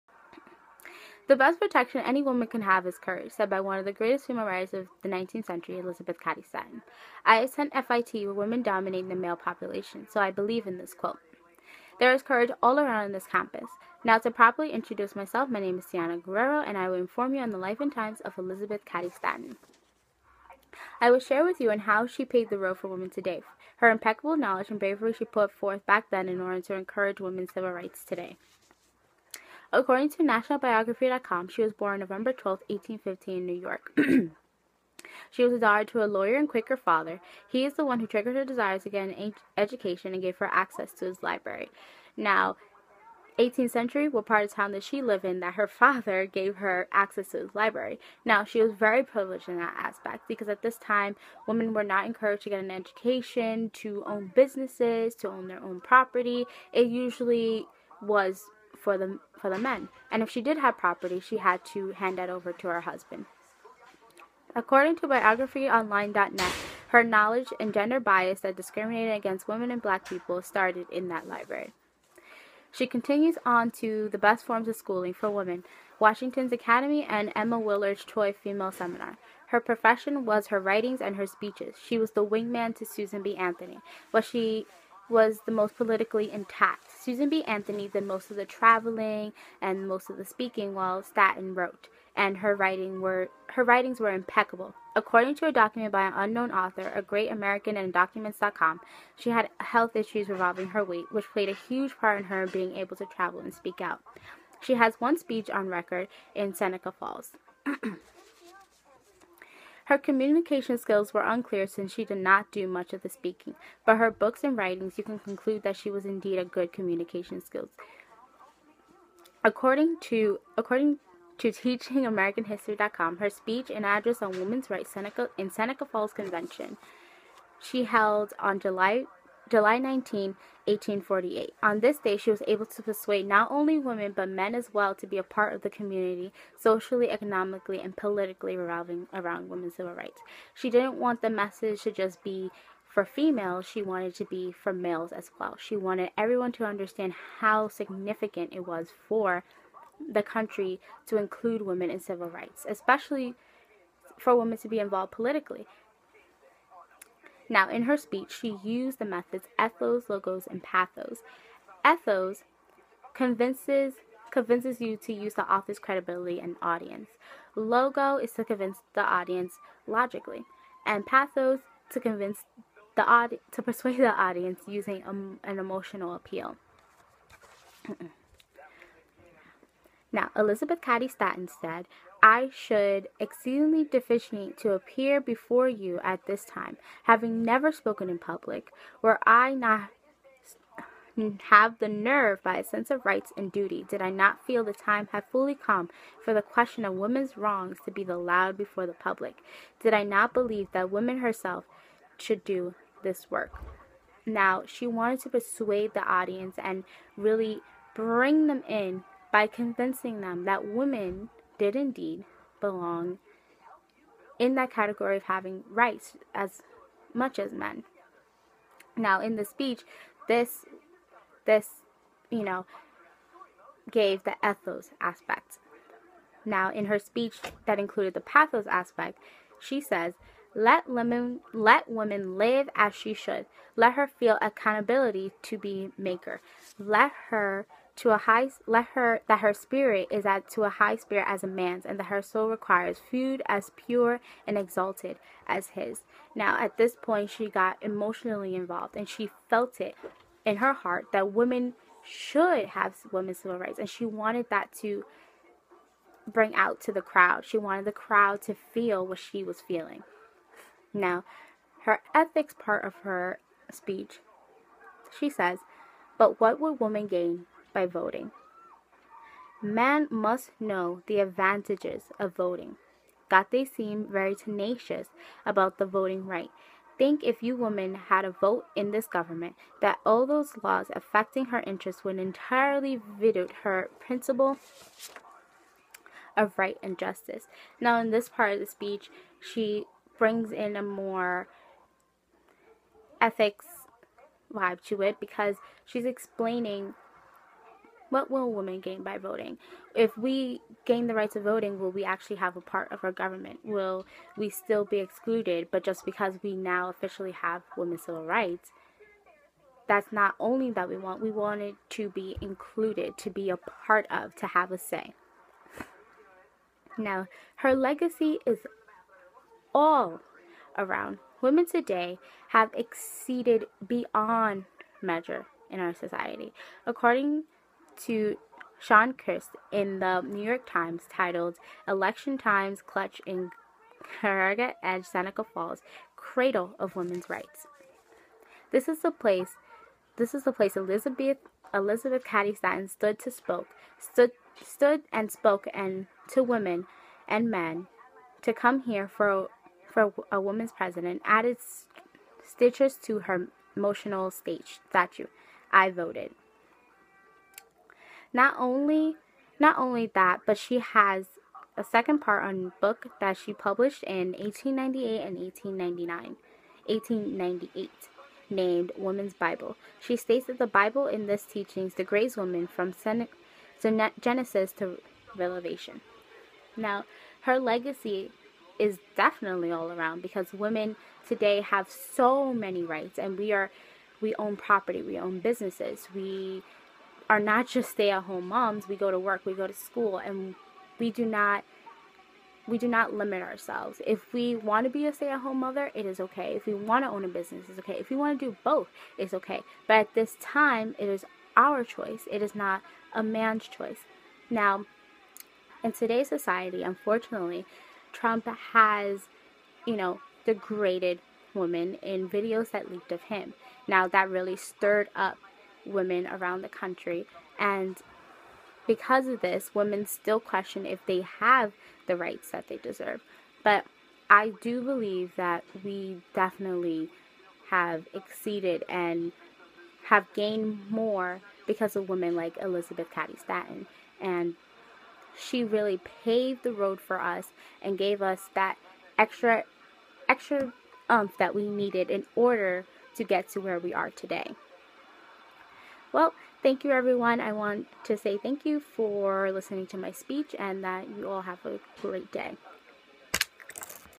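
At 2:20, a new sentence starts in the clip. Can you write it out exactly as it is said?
She didn't want the message to just be for females, she wanted to be for males as well.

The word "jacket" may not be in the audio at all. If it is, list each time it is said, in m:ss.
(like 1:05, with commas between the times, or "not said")
not said.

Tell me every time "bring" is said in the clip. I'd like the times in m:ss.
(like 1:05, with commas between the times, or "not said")
3:27, 4:16, 4:50.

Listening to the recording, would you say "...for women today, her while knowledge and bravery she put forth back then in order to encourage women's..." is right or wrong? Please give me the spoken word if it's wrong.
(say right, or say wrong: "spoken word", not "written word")
wrong: "impeccable", not "while".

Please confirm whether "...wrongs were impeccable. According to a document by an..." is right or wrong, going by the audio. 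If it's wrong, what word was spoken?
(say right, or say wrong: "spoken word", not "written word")
wrong: "writings", not "wrongs".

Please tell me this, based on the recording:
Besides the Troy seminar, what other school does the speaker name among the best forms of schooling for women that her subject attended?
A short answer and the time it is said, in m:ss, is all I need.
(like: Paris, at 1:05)
Washington's Academy, at 1:15.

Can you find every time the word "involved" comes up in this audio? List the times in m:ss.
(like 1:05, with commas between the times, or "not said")
2:34, 4:08.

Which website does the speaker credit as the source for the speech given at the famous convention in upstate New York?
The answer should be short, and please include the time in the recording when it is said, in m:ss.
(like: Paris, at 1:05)
teachingamericanhistory.com, at 2:01.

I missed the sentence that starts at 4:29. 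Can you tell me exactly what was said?
Men must know the advantages of voting, that they seem very tenacious about the voting right.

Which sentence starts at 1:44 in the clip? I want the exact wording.
She has one speech on record in Seneca Falls.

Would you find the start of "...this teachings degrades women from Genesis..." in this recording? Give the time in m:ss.
6:11.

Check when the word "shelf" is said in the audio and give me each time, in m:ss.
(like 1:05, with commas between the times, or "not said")
not said.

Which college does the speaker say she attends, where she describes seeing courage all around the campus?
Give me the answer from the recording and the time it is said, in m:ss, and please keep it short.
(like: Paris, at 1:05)
FIT, at 0:07.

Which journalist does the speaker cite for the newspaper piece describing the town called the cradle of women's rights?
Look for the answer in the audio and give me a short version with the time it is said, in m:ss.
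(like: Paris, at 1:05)
Sean Kirst, at 5:28.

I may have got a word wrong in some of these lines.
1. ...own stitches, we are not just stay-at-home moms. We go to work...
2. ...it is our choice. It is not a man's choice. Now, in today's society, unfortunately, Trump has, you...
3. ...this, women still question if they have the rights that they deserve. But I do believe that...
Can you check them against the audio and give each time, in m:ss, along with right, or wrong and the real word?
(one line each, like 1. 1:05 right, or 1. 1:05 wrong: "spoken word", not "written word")
1. 6:25 wrong: "businesses", not "stitches"
2. 6:40 right
3. 6:59 right.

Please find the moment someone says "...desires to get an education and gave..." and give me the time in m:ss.
0:38.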